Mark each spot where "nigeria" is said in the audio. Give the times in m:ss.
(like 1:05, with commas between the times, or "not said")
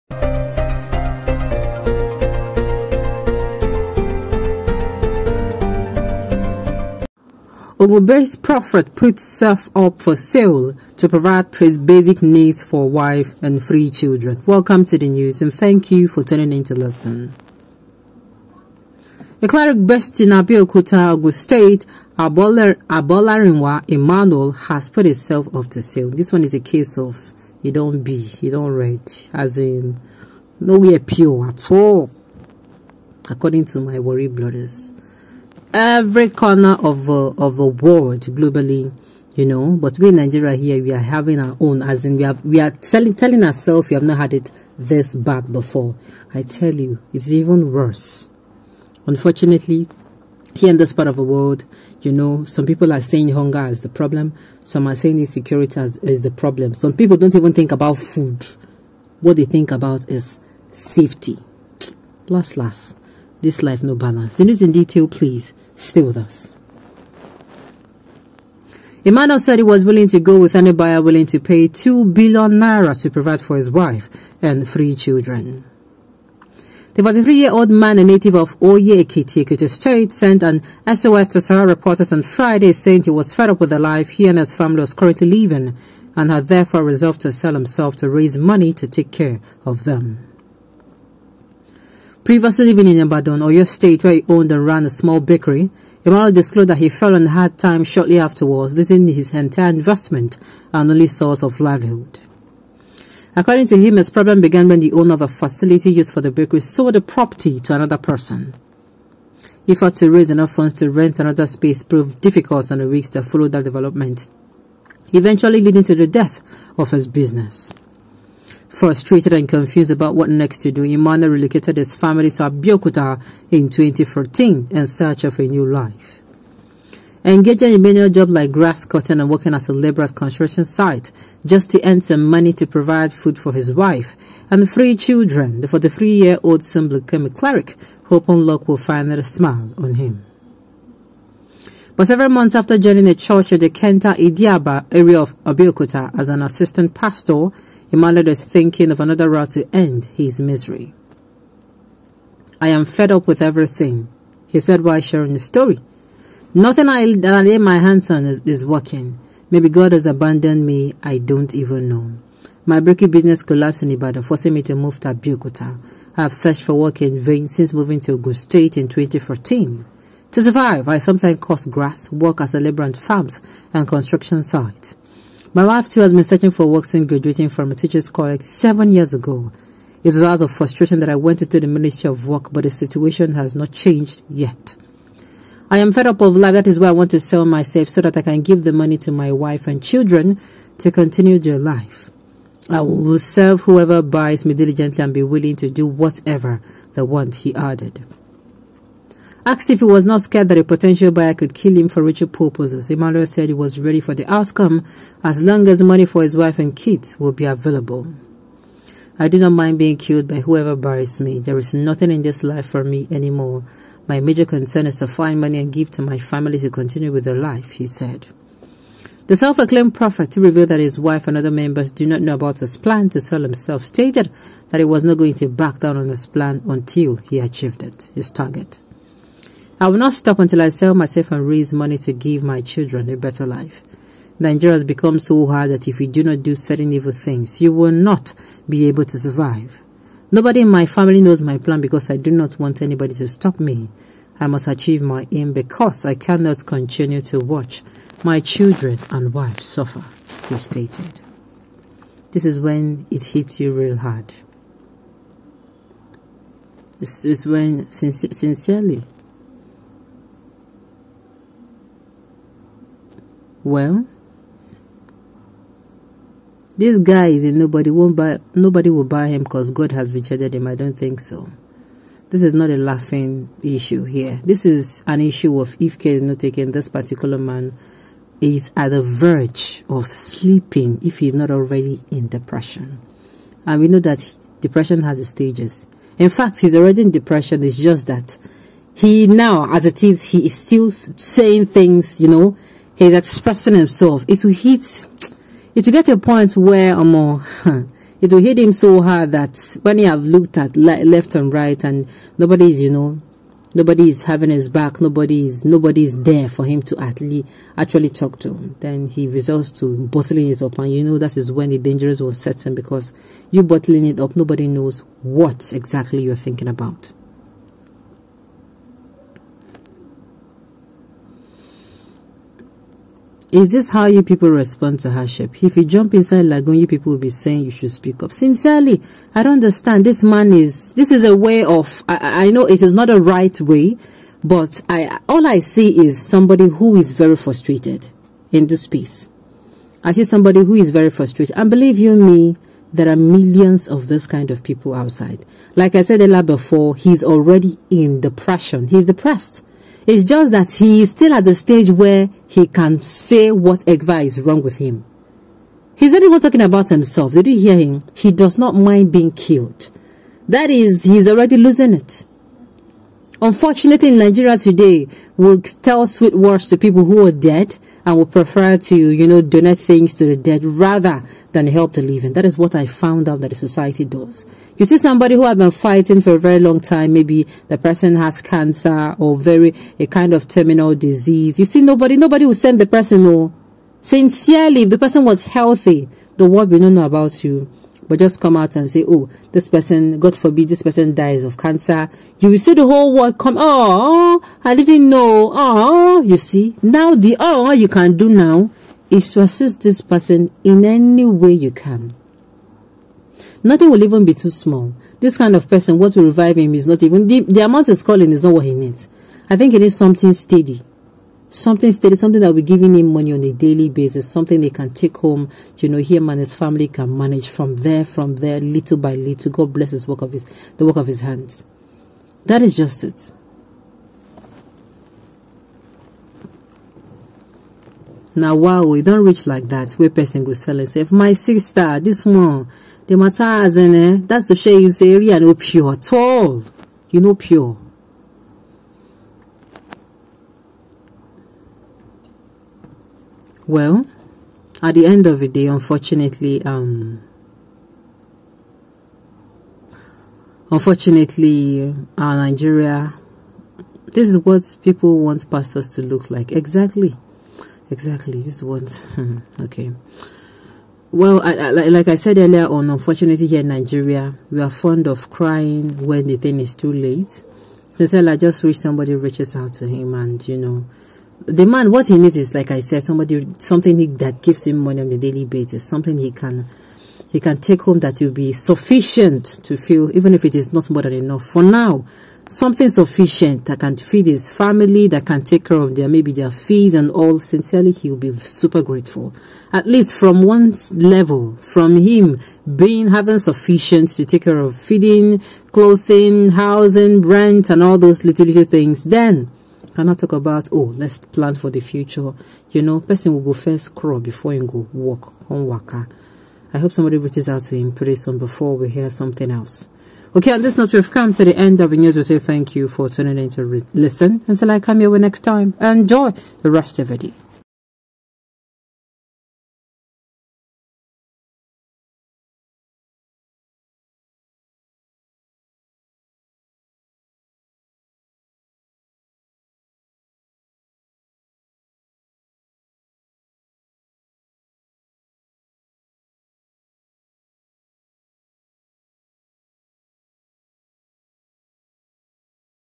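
0:40, 3:54, 6:04, 7:32, 7:43.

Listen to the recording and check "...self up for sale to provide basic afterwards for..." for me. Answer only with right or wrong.
wrong.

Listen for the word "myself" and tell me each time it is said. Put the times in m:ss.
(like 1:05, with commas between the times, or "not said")
3:07, 3:50.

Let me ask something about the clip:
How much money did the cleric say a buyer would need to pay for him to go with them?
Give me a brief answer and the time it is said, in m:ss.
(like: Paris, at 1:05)
2 billion naira, at 1:11.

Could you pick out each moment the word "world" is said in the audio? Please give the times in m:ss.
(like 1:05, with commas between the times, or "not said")
0:37, 0:51, 6:26, 6:33.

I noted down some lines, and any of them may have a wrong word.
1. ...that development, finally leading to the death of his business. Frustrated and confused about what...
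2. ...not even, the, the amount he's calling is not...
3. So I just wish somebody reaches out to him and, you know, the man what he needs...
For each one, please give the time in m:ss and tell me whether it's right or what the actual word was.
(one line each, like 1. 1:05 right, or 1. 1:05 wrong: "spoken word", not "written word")
1. 1:53 wrong: "eventually", not "finally"
2. 6:46 right
3. 7:48 right.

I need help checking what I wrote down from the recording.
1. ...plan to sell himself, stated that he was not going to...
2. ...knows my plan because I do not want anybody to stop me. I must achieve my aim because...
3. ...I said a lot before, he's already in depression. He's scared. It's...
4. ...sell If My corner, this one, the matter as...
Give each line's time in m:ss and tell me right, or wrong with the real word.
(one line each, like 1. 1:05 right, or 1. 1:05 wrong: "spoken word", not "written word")
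1. 3:42 right
2. 4:01 right
3. 5:45 wrong: "depressed", not "scared"
4. 7:10 wrong: "sister", not "corner".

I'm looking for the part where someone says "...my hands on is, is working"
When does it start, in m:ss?
2:37.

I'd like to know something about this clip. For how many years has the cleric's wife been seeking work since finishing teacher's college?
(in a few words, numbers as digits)
7.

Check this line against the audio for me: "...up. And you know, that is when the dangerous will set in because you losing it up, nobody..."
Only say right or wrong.
wrong.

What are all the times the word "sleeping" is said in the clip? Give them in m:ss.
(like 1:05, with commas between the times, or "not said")
4:40.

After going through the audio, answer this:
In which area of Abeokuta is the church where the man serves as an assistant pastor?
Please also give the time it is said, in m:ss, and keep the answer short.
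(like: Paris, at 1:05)
Kenta Idiaba, at 2:23.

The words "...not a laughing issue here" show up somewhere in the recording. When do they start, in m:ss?
4:32.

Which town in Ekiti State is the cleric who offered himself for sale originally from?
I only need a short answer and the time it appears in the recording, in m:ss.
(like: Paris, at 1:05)
Oye Ekiti, at 1:18.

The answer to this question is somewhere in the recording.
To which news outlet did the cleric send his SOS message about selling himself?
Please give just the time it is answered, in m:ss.
1:21.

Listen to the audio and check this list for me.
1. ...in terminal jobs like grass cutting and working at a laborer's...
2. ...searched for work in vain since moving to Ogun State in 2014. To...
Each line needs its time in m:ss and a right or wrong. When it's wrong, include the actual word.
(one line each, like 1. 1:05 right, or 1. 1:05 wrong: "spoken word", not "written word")
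1. 2:07 wrong: "manual", not "terminal"
2. 2:46 right.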